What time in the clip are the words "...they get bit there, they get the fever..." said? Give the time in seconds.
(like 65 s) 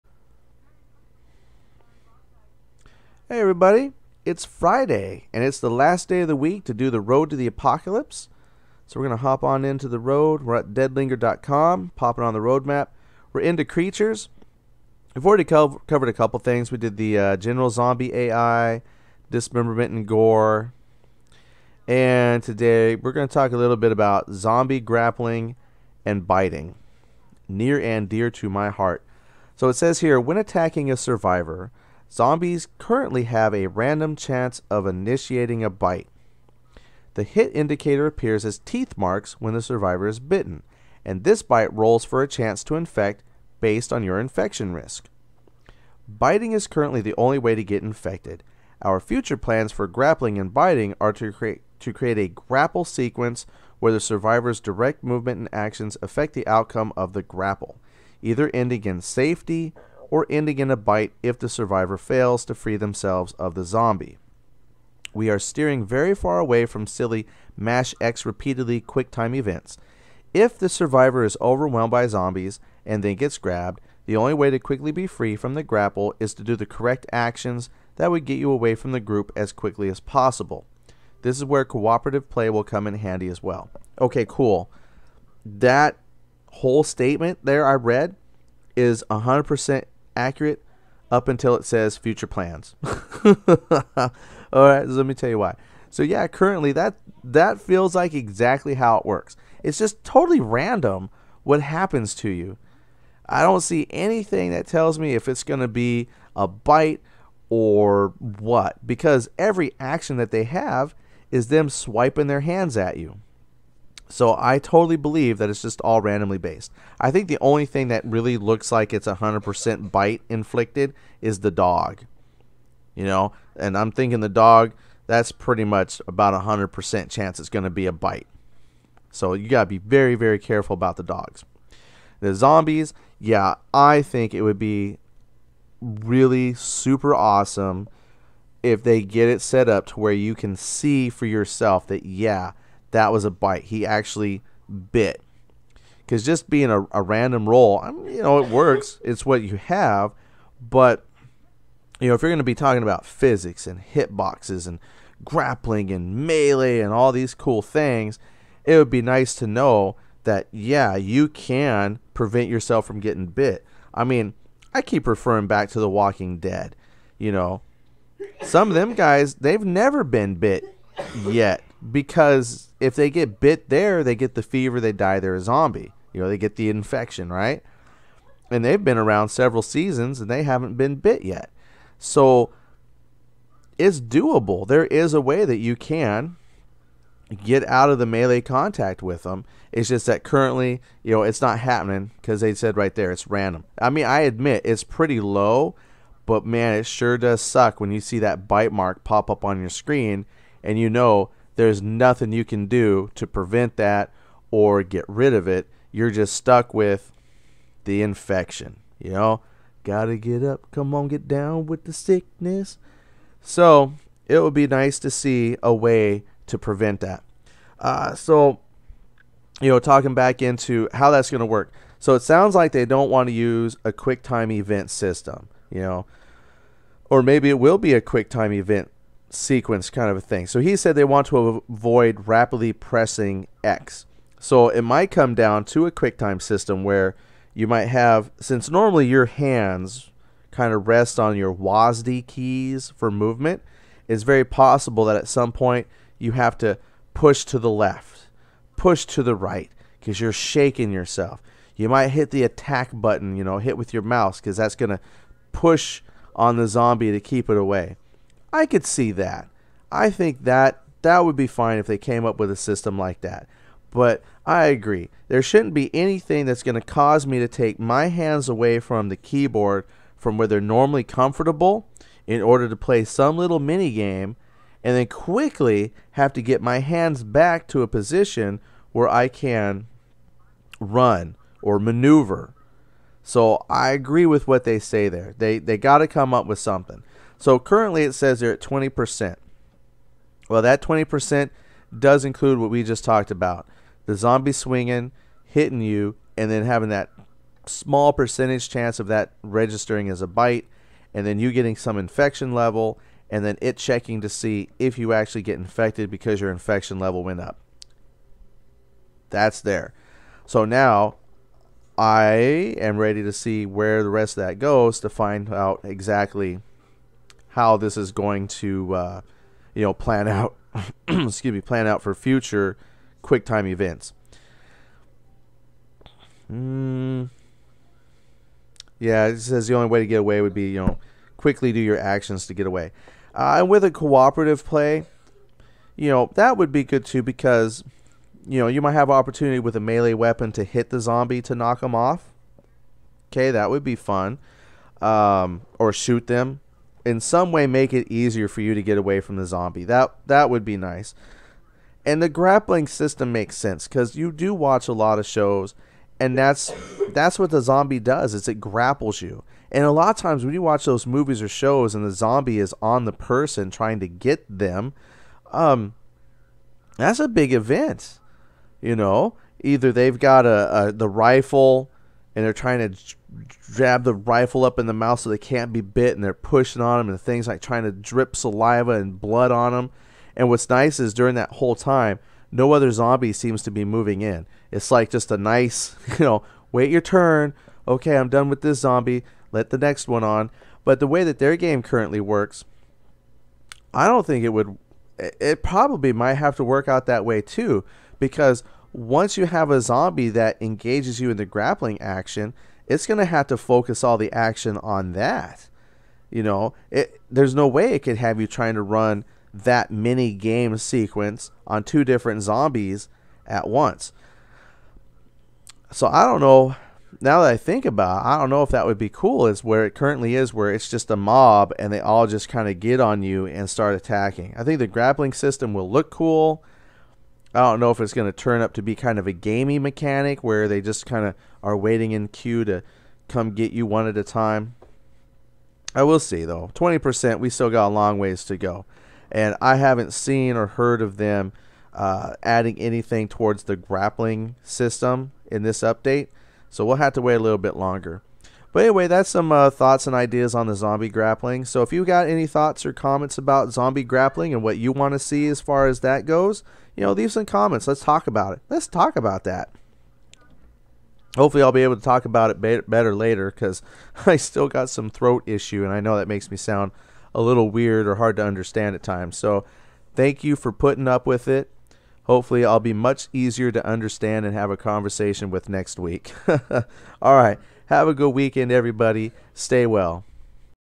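172 s.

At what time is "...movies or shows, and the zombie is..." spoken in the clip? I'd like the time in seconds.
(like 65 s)
361 s.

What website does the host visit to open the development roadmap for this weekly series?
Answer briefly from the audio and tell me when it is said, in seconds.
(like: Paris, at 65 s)
deadlinger.com, at 10 s.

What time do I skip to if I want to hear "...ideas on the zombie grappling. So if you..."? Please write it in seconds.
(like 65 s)
450 s.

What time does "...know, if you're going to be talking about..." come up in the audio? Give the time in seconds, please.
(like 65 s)
152 s.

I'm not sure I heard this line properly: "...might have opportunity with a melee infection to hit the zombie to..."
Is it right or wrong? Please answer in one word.
wrong.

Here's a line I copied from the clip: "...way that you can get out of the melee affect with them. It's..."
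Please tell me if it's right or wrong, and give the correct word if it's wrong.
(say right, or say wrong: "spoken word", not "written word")
wrong: "contact", not "affect".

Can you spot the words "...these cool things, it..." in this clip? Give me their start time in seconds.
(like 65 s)
157 s.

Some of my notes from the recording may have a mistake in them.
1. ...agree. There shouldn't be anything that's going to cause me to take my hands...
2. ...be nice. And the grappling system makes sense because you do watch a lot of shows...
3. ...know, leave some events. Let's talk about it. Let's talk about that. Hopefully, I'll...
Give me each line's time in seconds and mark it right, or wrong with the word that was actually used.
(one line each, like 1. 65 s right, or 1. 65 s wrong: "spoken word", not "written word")
1. 264 s right
2. 350 s right
3. 457 s wrong: "comments", not "events".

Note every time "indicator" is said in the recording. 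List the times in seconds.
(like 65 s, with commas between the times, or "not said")
37 s.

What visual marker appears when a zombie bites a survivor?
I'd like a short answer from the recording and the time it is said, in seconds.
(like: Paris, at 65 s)
Teeth marks, at 38 s.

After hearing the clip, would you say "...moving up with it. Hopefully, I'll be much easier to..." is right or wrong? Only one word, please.
wrong.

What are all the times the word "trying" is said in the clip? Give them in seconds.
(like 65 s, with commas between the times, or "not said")
363 s, 372 s, 377 s, 408 s.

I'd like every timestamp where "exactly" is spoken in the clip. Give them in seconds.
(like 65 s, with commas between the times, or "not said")
98 s, 315 s.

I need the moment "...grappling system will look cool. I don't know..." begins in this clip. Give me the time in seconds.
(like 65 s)
424 s.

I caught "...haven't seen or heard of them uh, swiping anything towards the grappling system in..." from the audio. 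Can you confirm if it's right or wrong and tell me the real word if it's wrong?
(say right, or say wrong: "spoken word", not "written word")
wrong: "adding", not "swiping".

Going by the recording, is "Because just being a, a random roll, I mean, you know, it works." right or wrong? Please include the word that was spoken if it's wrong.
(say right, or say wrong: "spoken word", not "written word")
right.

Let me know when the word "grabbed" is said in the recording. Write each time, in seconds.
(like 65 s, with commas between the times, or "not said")
73 s.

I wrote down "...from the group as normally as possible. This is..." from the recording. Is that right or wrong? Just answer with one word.
wrong.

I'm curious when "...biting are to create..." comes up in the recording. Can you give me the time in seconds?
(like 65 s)
50 s.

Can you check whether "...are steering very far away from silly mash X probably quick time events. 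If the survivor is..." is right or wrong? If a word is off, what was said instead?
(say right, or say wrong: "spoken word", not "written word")
wrong: "repeatedly", not "probably".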